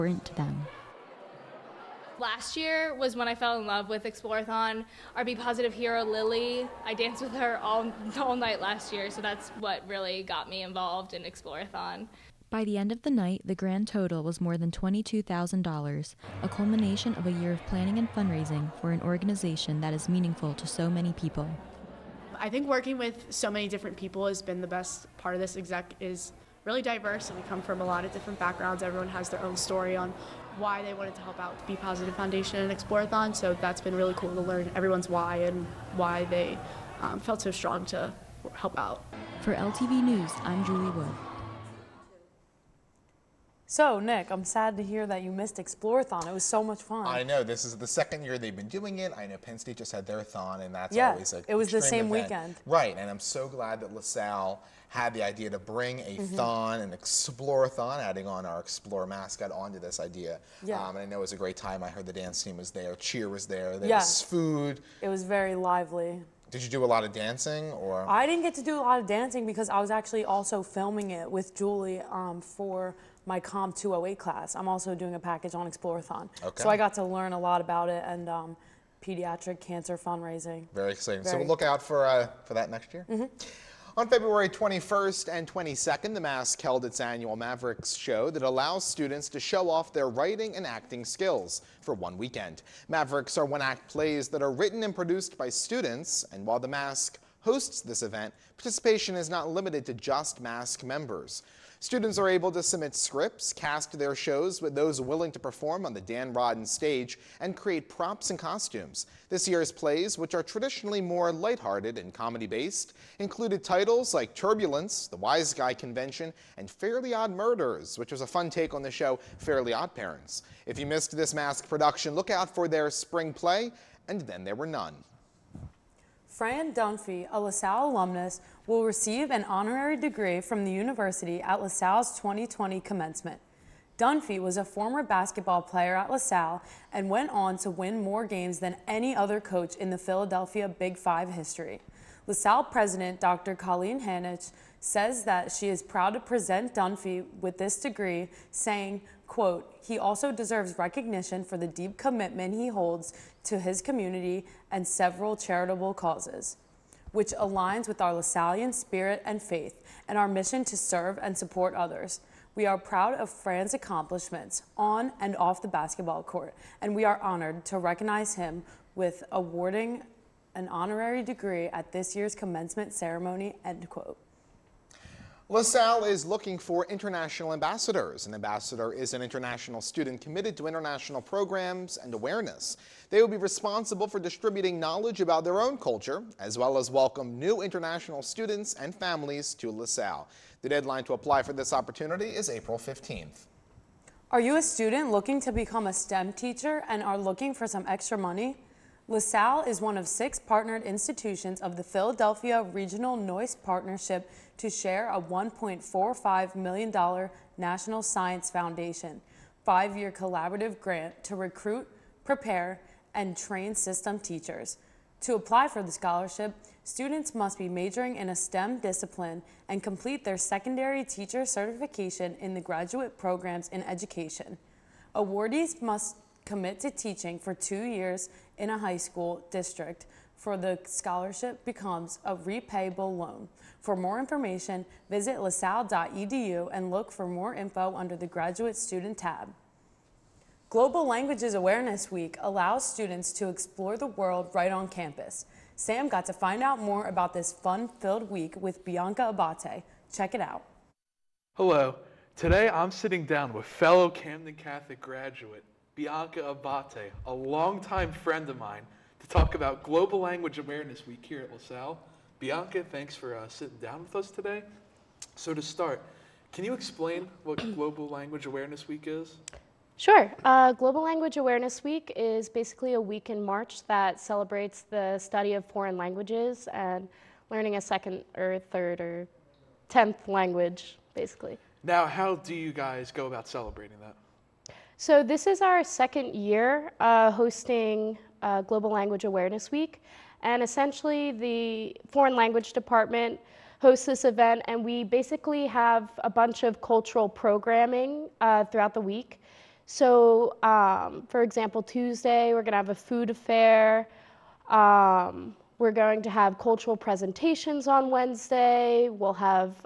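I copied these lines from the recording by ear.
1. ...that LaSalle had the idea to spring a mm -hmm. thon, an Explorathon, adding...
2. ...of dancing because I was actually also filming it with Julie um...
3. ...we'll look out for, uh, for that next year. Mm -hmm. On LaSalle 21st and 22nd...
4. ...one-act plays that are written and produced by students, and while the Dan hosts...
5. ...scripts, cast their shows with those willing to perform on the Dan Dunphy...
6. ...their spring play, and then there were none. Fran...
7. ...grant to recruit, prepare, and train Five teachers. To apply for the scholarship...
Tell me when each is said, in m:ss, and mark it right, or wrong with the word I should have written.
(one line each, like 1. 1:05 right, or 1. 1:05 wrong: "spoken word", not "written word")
1. 0:53 wrong: "bring", not "spring"
2. 1:09 right
3. 1:21 wrong: "February", not "LaSalle"
4. 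1:33 wrong: "Masque", not "Dan"
5. 1:42 wrong: "Rodden", not "Dunphy"
6. 2:02 right
7. 3:30 wrong: "STEM", not "Five".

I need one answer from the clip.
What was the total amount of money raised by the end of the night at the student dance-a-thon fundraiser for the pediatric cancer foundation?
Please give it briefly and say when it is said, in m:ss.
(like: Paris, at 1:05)
more than $22,000, at 0:14.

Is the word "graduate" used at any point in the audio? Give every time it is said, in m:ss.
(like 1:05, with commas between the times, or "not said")
3:42, 3:58, 4:14.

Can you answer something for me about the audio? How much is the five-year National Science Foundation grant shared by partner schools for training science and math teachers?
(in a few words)
$1.45 million.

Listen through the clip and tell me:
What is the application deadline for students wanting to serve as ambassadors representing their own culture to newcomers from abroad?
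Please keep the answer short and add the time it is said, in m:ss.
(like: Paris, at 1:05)
April 15th, at 3:12.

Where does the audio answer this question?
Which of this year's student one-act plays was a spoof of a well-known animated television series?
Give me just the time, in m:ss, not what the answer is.
1:56.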